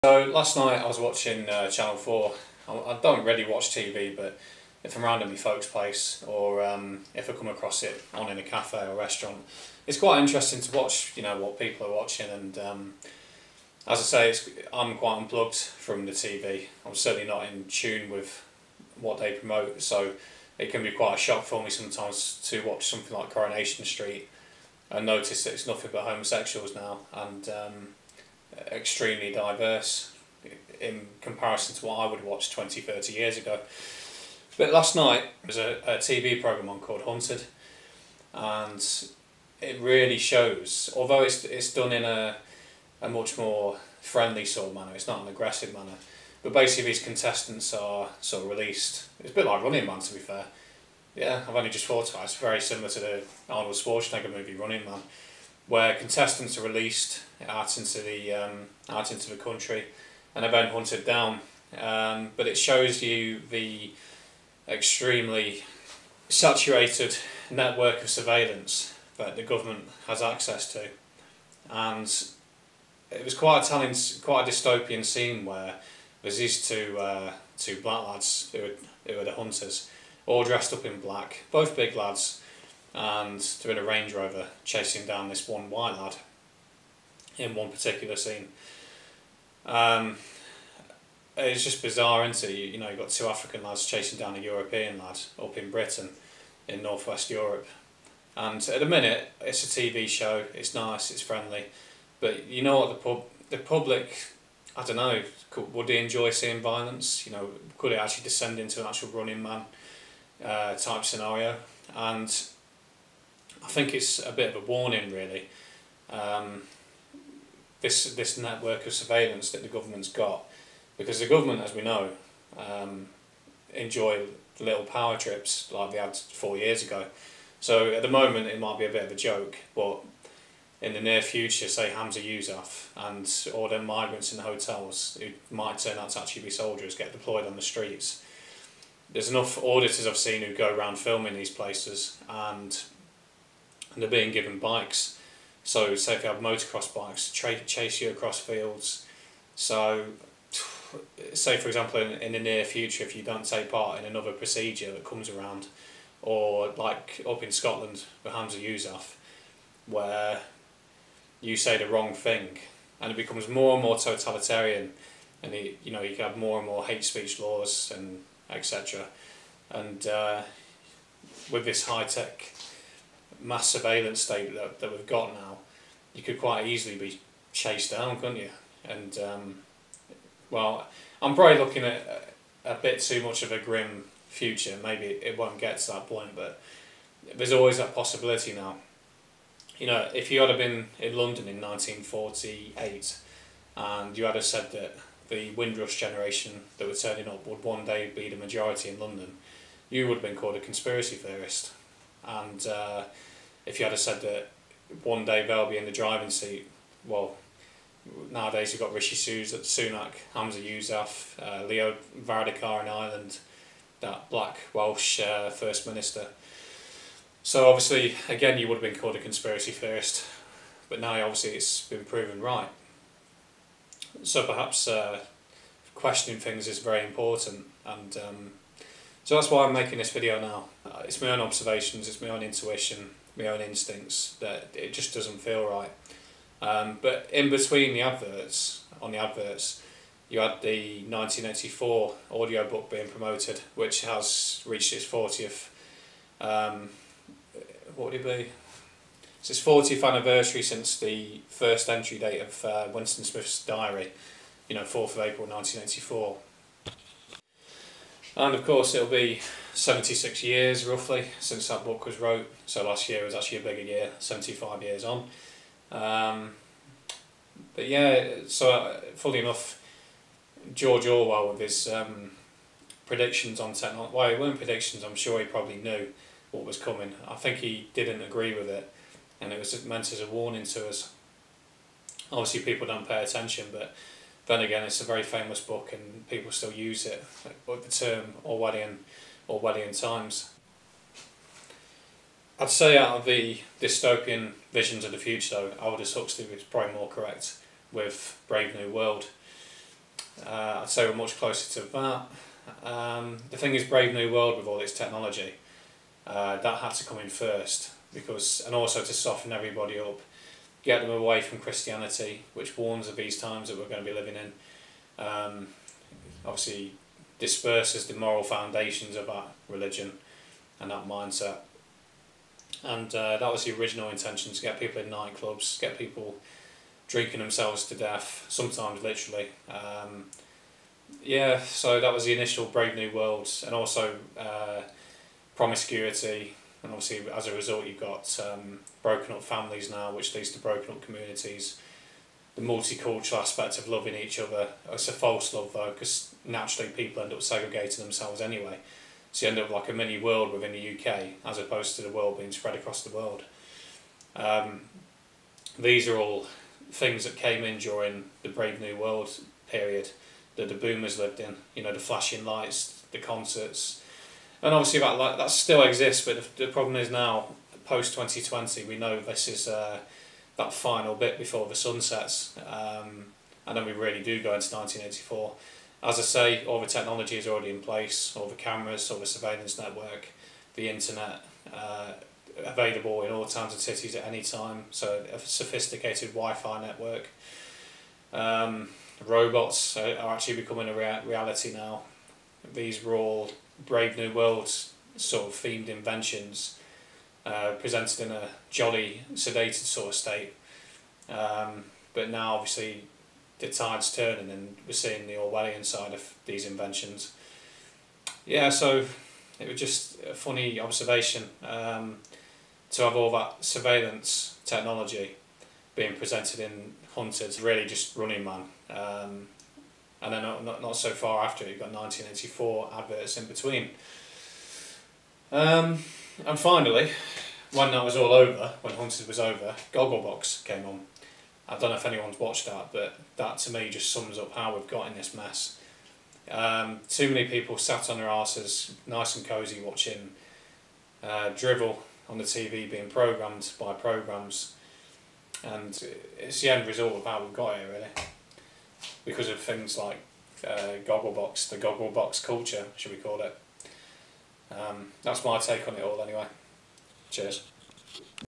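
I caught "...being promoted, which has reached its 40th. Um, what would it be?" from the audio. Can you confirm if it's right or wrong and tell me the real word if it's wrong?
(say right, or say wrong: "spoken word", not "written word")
right.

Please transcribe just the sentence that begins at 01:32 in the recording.
You, you know, you've got two African lads chasing down a European lad up in Britain, in northwest Europe.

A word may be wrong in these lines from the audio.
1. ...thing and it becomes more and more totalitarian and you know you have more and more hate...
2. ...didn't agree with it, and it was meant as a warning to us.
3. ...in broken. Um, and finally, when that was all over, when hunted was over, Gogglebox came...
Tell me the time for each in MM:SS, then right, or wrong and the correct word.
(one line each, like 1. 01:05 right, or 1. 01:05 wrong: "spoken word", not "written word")
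1. 02:42 right
2. 04:37 right
3. 07:03 wrong: "between", not "broken".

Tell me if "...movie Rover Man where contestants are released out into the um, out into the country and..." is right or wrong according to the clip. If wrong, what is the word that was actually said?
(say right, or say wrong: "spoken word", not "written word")
wrong: "Running", not "Rover".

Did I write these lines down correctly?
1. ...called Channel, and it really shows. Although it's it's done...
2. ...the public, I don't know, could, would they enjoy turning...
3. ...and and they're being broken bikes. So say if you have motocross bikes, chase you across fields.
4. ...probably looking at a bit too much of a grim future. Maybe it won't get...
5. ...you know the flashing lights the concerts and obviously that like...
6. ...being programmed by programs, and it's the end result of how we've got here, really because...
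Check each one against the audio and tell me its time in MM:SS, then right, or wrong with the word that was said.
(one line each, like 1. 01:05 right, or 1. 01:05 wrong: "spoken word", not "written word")
1. 00:36 wrong: "Hunted", not "Channel"
2. 01:43 wrong: "seeing", not "turning"
3. 02:22 wrong: "given", not "broken"
4. 03:01 right
5. 06:01 right
6. 07:22 right.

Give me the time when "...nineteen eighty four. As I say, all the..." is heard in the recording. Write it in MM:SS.
06:14.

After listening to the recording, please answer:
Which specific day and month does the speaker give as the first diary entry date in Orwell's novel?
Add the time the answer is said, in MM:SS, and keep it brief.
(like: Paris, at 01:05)
4th of April, at 04:14.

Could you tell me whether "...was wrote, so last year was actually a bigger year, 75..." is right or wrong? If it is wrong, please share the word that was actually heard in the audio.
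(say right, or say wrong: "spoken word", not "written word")
right.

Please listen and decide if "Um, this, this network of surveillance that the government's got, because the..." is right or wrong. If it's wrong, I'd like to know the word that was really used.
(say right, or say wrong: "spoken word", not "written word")
right.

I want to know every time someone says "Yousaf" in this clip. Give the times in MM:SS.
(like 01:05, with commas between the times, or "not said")
02:12, 02:38, 03:30.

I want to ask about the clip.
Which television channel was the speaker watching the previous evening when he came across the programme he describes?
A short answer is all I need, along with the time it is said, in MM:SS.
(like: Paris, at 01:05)
Channel 4, at 00:01.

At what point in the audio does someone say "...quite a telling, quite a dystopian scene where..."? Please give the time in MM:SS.
01:13.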